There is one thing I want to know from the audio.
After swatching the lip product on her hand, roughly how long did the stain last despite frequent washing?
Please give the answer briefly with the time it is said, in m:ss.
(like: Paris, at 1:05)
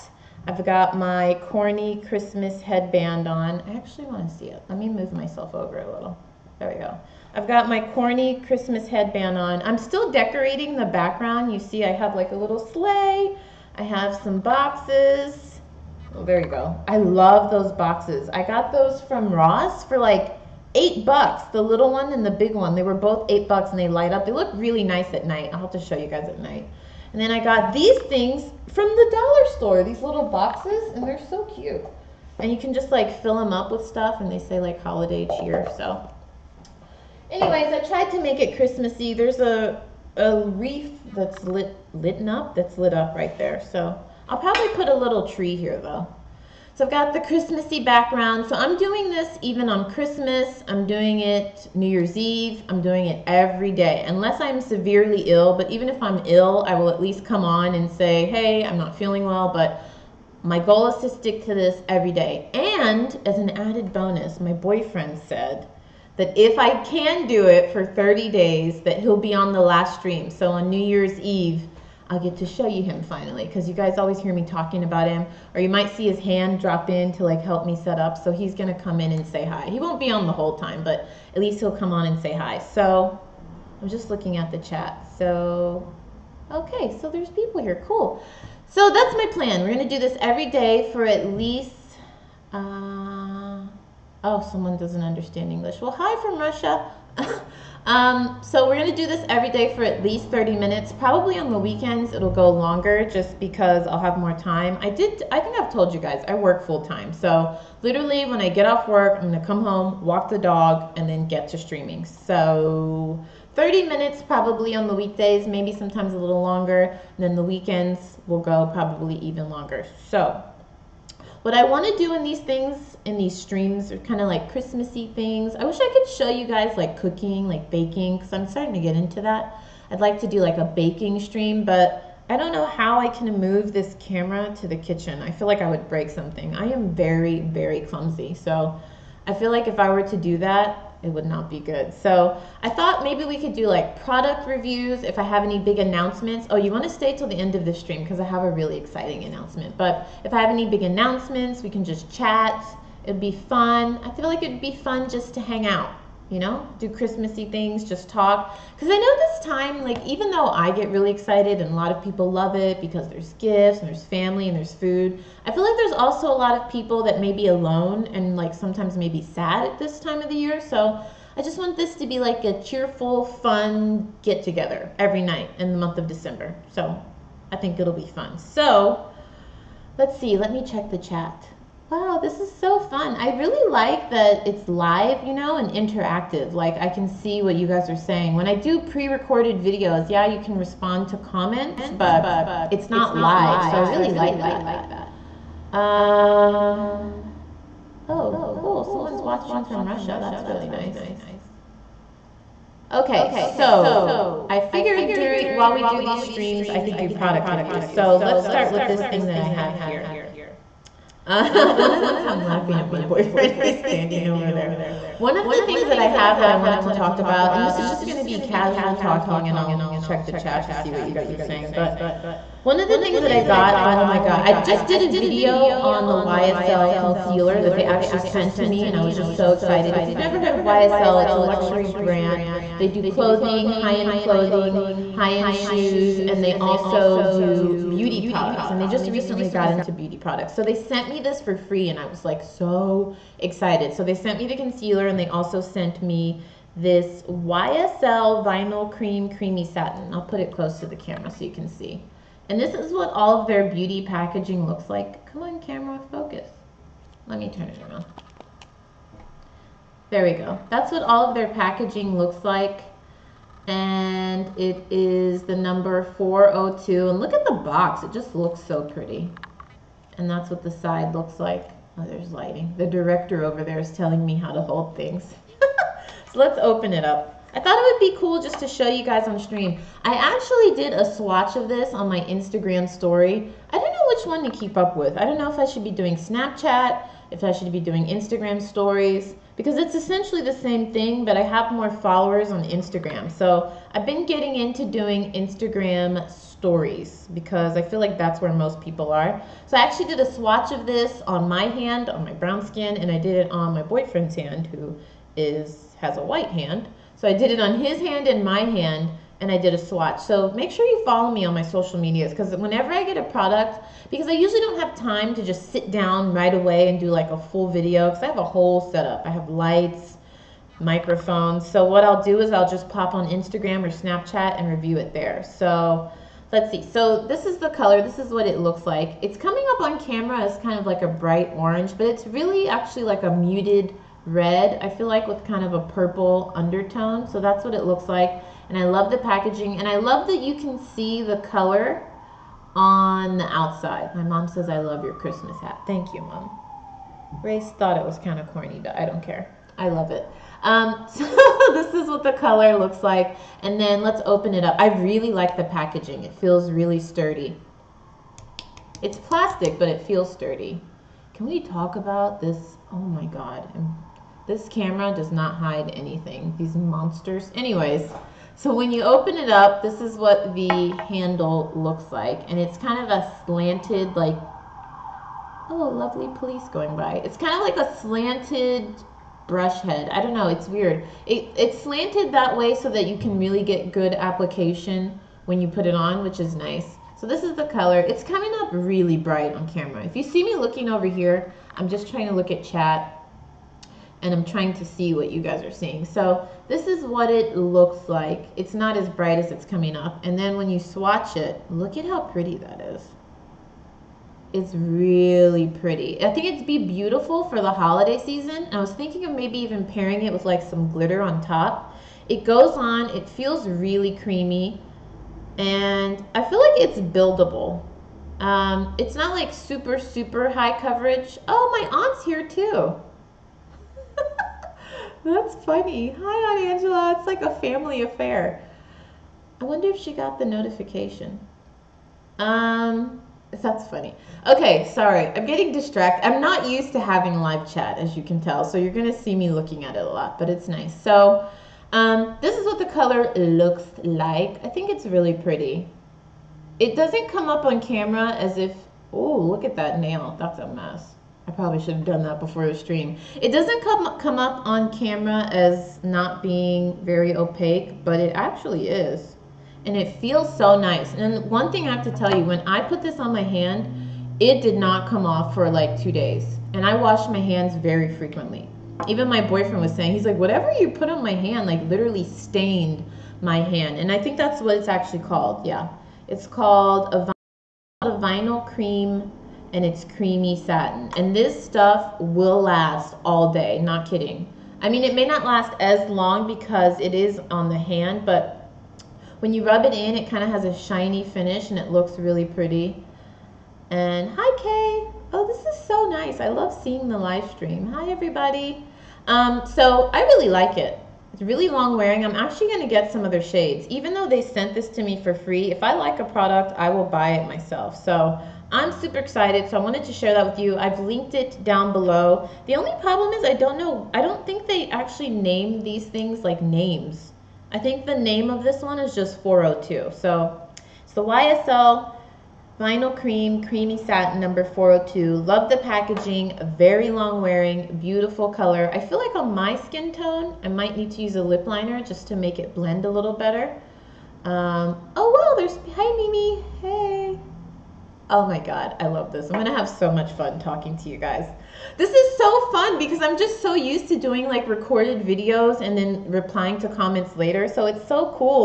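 2 days, at 7:46.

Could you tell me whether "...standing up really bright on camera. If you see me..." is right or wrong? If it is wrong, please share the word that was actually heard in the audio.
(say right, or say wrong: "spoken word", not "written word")
wrong: "coming", not "standing".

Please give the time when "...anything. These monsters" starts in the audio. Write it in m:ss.
6:05.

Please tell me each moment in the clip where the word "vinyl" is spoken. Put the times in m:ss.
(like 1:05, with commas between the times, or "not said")
4:08, 7:58, 8:42.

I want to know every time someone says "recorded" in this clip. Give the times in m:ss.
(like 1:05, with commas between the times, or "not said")
3:09, 9:04.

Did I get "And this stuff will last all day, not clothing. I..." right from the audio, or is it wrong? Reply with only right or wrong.
wrong.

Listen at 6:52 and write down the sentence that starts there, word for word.
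It goes on, it feels really creamy, and I feel like it's buildable.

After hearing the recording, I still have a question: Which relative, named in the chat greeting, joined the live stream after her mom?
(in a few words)
Aunt Angela.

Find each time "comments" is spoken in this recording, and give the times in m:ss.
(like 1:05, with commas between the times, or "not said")
3:11, 9:06.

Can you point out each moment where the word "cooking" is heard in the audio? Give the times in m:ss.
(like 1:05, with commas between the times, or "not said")
2:06.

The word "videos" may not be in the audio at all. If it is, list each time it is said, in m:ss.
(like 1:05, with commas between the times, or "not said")
3:09, 3:45, 5:17, 9:05.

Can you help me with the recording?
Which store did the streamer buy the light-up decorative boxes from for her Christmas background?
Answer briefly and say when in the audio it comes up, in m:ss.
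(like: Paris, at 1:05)
Ross, at 0:19.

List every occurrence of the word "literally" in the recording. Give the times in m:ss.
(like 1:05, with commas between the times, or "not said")
1:47, 7:51.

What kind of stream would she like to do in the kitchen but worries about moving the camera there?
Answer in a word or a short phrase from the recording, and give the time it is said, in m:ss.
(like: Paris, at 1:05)
Baking stream, at 2:10.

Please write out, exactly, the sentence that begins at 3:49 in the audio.
If you've never heard of YSL, it's a luxury brand.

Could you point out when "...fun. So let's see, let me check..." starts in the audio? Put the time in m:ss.
2:58.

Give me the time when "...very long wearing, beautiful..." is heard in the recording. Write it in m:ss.
8:46.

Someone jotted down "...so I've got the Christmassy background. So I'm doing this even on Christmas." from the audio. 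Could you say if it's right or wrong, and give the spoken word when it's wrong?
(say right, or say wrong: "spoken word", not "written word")
right.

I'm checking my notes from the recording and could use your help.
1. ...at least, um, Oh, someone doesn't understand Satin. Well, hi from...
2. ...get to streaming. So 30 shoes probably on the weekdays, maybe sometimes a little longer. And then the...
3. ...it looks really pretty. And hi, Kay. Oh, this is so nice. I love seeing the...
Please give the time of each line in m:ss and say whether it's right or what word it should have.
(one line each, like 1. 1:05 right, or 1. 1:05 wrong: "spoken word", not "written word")
1. 1:31 wrong: "English", not "Satin"
2. 1:51 wrong: "minutes", not "shoes"
3. 8:11 right.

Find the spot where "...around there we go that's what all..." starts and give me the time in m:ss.
4:17.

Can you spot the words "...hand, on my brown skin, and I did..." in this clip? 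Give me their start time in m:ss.
5:01.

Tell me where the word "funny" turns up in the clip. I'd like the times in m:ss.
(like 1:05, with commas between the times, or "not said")
7:05, 7:13.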